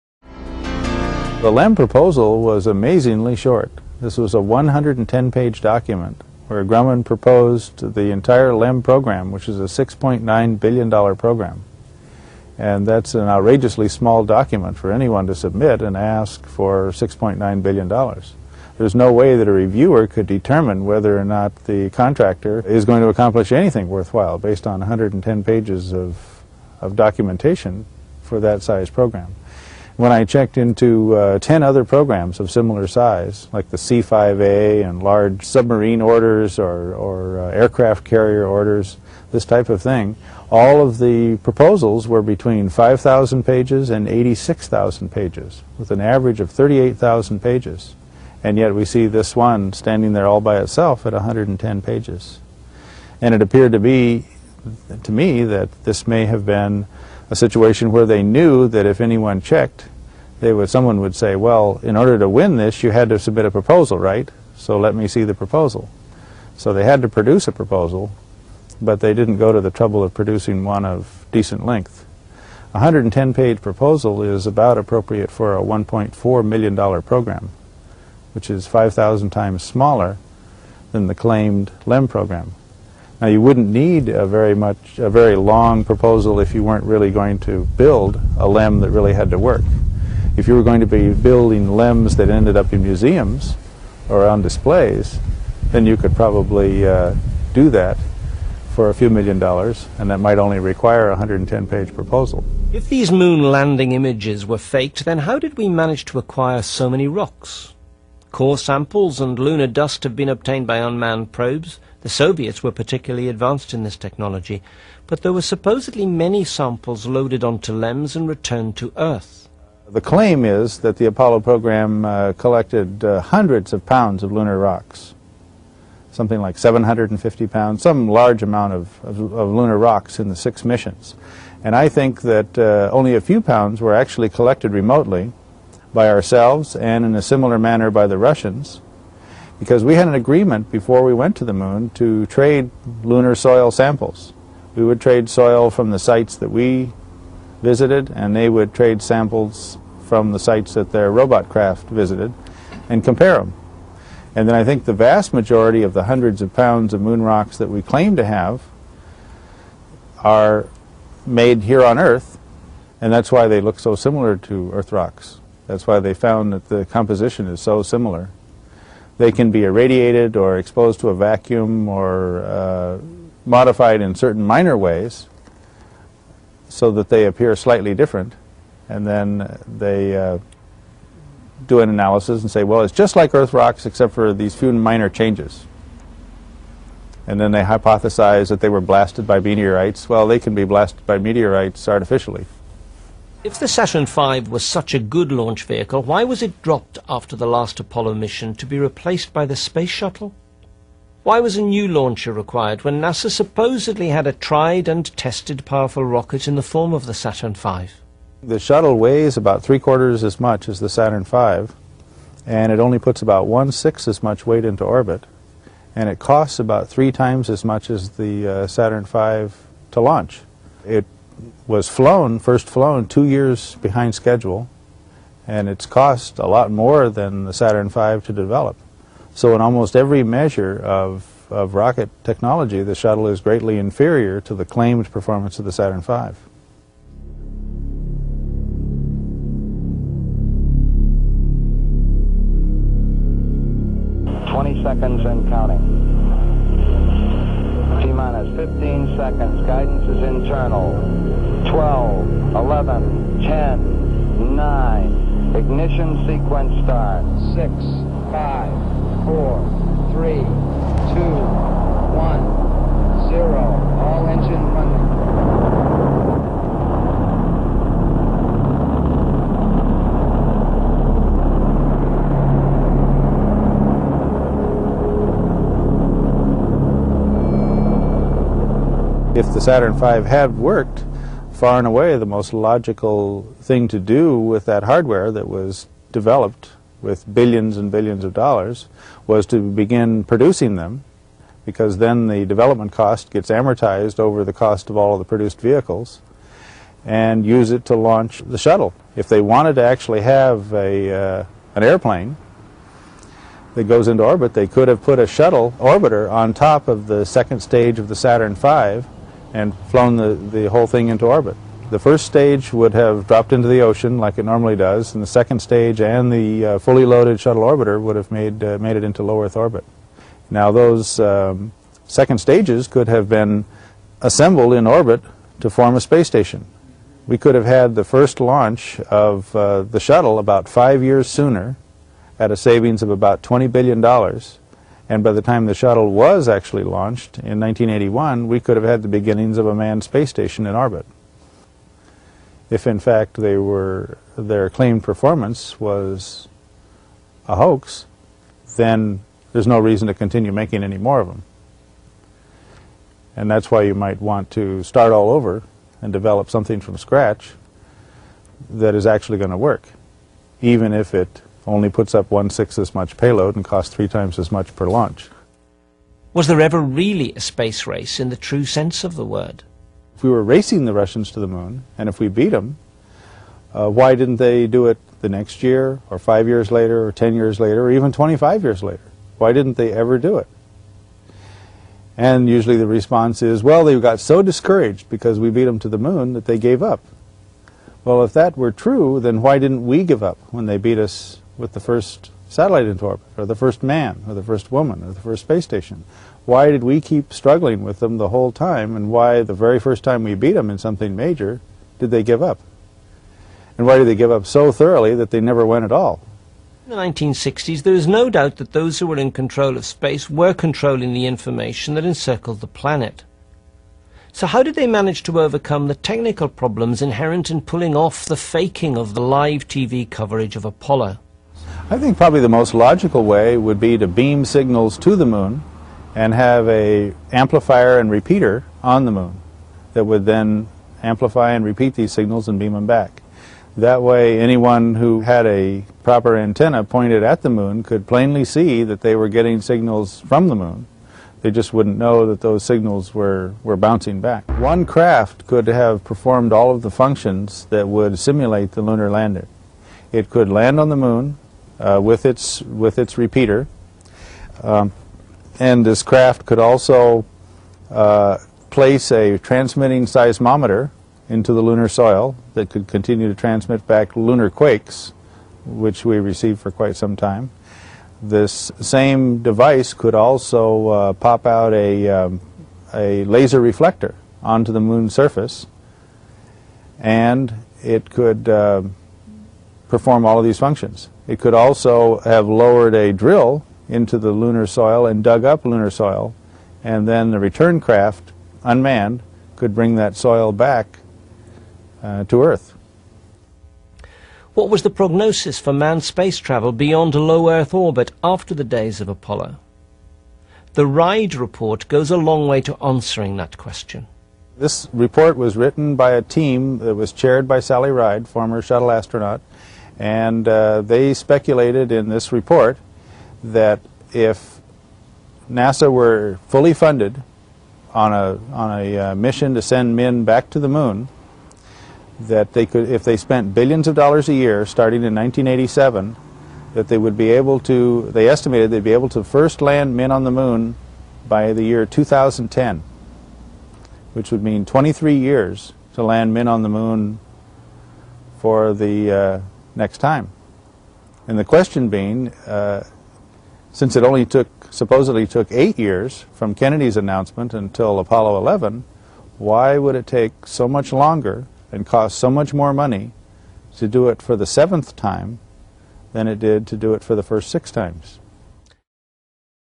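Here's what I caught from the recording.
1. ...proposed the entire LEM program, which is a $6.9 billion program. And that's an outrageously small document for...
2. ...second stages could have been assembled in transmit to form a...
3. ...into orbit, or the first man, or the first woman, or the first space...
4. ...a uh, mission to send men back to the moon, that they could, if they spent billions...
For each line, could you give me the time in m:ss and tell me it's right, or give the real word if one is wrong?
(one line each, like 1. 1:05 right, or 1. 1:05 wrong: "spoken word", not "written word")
1. 0:07 right
2. 5:22 wrong: "orbit", not "transmit"
3. 6:32 right
4. 8:38 right.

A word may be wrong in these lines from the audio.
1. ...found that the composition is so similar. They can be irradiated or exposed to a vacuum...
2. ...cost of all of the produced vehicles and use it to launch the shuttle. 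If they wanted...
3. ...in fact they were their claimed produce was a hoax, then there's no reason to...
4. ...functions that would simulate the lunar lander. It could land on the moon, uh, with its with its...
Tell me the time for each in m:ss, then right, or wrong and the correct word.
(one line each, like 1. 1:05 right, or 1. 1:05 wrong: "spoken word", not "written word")
1. 2:46 right
2. 4:54 right
3. 5:42 wrong: "performance", not "produce"
4. 7:26 right.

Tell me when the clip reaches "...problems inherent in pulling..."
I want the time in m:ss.
6:56.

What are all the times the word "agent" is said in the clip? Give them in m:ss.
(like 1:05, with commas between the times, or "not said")
not said.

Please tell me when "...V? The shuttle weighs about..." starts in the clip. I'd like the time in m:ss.
3:27.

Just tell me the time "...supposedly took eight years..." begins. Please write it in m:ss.
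9:04.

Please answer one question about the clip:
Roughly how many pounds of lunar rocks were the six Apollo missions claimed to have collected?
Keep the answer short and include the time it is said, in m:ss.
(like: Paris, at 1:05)
750 pounds, at 2:06.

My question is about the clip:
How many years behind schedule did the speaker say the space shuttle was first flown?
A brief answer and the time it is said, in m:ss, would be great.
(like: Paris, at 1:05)
two years, at 3:43.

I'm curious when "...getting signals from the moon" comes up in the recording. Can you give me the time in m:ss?
7:19.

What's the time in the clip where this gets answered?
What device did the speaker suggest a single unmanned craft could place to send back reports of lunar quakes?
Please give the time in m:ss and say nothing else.
7:39.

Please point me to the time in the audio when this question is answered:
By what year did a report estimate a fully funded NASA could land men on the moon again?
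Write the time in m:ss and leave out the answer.
8:51.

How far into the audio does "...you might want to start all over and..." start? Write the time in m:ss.
5:53.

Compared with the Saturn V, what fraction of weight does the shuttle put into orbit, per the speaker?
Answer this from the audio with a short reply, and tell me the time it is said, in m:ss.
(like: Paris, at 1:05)
one sixth, at 3:33.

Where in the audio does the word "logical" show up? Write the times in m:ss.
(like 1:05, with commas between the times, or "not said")
4:42, 7:02.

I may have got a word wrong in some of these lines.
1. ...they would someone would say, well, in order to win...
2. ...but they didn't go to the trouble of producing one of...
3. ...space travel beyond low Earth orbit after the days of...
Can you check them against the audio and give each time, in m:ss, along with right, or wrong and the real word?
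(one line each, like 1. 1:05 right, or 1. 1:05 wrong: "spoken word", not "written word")
1. 1:00 right
2. 1:08 right
3. 8:16 right.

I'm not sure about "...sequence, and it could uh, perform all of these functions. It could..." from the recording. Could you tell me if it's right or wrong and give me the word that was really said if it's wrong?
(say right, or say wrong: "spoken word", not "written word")
wrong: "surface", not "sequence".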